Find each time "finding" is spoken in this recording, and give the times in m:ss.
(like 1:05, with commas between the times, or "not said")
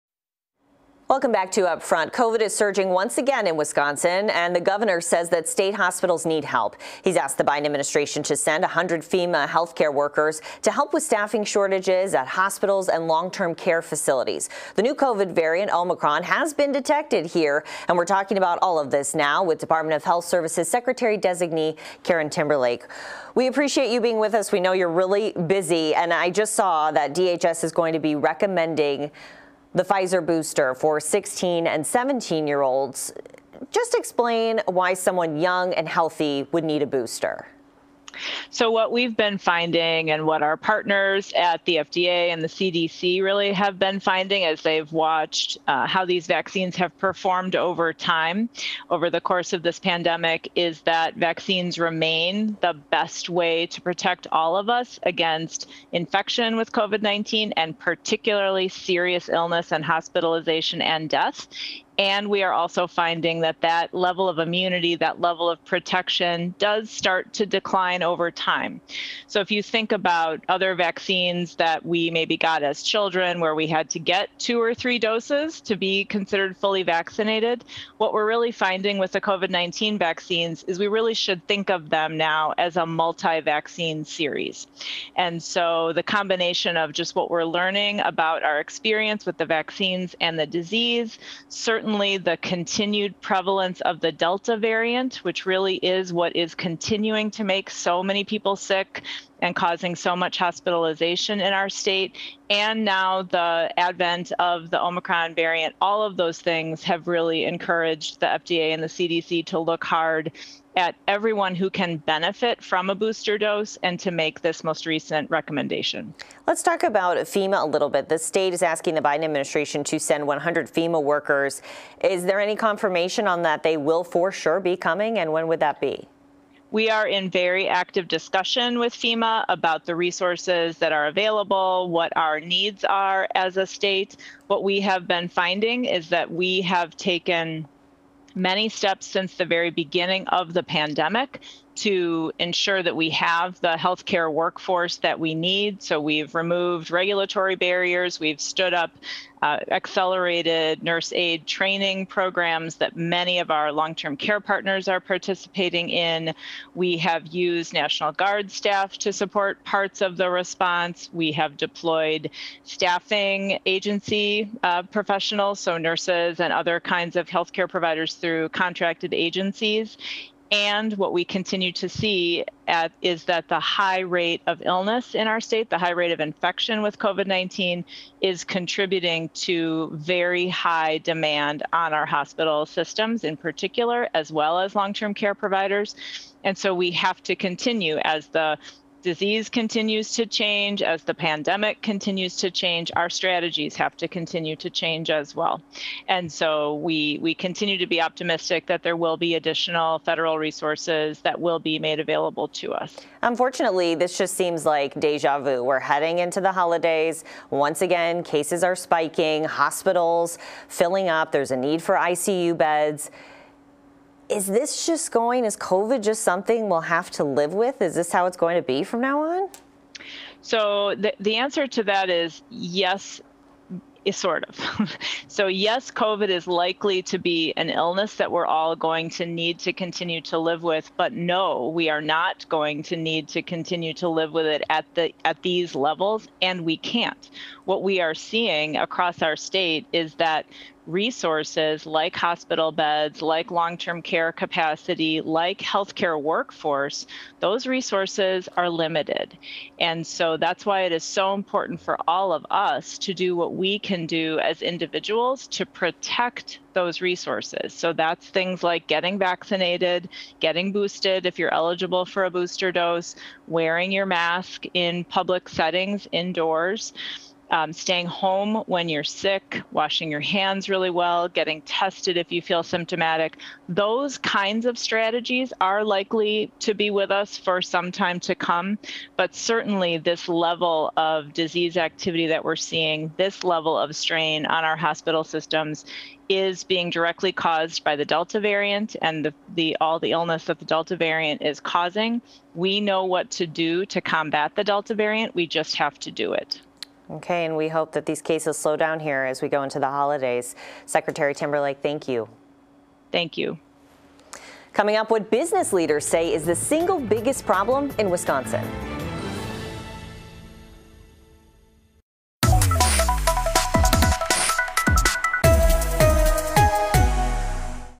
0:39, 0:43, 1:02, 1:18, 2:15.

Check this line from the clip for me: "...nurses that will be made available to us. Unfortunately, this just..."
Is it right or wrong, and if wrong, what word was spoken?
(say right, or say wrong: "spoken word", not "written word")
wrong: "resources", not "nurses".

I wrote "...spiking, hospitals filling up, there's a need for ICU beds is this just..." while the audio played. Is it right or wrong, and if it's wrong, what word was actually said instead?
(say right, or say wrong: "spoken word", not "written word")
right.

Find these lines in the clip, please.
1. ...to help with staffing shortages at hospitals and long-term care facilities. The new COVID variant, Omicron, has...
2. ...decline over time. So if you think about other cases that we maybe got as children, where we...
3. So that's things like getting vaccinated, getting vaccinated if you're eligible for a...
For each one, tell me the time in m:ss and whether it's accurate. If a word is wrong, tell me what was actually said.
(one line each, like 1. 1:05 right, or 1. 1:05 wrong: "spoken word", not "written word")
1. 0:10 right
2. 1:07 wrong: "vaccines", not "cases"
3. 4:17 wrong: "boosted", not "vaccinated".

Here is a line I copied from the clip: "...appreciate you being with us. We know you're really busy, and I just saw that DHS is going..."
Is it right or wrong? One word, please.
right.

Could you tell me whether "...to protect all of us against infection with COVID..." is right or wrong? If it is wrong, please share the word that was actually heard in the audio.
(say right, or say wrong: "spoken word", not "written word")
right.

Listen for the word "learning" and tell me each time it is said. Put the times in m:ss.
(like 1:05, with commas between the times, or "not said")
1:27.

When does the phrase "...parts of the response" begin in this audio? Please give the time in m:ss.
2:39.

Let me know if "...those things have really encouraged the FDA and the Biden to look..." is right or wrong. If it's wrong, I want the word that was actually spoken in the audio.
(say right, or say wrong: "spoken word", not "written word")
wrong: "CDC", not "Biden".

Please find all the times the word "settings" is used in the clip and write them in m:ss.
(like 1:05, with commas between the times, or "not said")
4:25.